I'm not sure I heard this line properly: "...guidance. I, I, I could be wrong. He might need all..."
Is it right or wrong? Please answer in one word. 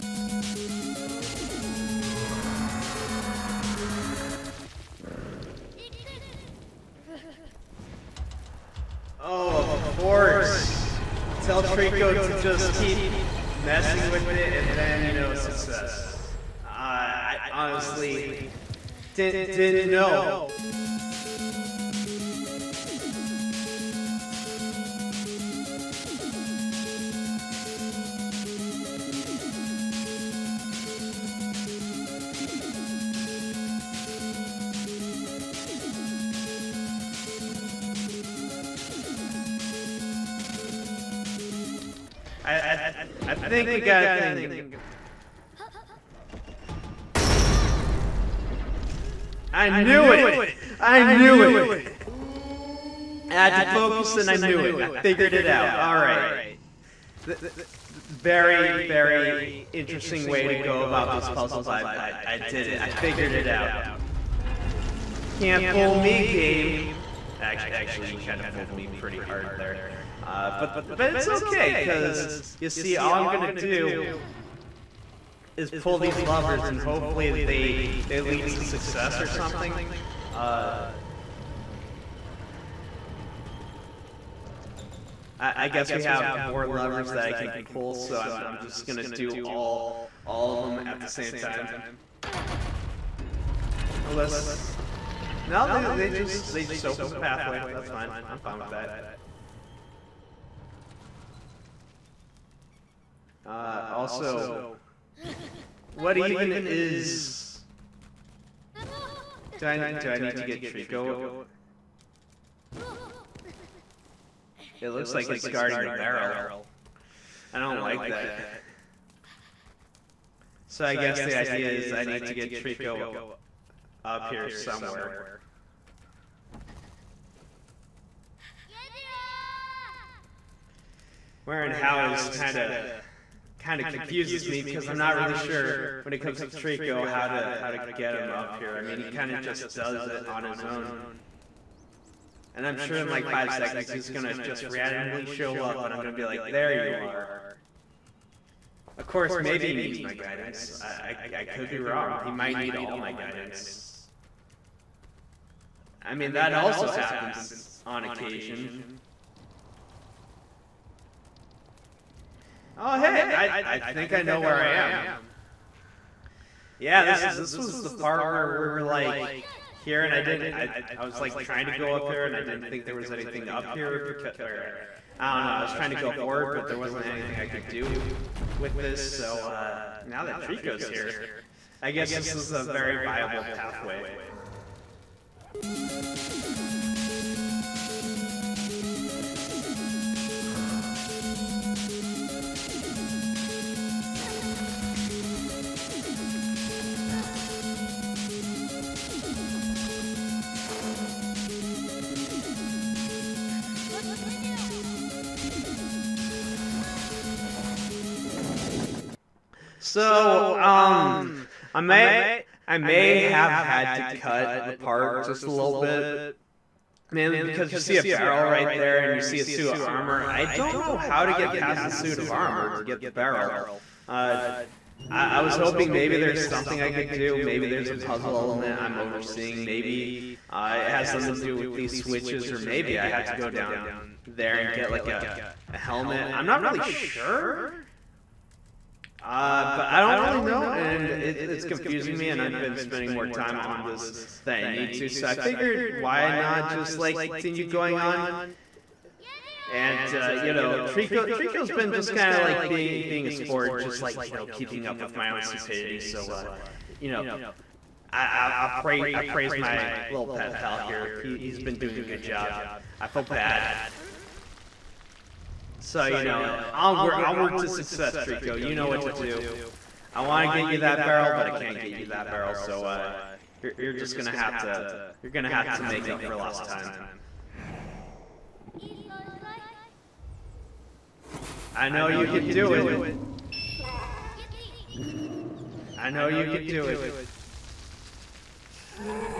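right.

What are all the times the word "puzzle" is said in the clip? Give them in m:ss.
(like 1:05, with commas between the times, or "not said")
1:01, 3:47.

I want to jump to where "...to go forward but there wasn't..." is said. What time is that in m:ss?
2:55.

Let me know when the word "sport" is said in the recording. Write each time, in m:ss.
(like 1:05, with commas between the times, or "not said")
4:13.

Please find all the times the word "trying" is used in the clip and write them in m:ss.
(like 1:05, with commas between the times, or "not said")
2:51, 2:55.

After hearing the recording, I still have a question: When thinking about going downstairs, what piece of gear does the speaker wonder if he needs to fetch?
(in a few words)
helmet.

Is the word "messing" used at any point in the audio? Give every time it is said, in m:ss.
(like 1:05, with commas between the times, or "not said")
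0:13.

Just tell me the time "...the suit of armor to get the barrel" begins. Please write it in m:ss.
3:41.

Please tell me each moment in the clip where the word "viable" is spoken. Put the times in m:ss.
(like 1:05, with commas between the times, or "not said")
3:02.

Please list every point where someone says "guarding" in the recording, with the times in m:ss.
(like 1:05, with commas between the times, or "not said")
1:55.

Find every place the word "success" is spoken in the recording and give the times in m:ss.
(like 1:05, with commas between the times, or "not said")
0:15, 1:18, 4:27.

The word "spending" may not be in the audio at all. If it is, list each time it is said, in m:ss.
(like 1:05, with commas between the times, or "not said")
4:02.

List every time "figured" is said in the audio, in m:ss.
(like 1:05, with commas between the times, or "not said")
0:54, 1:02, 4:05.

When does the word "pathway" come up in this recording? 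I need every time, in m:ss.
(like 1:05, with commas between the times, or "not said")
1:37, 3:03.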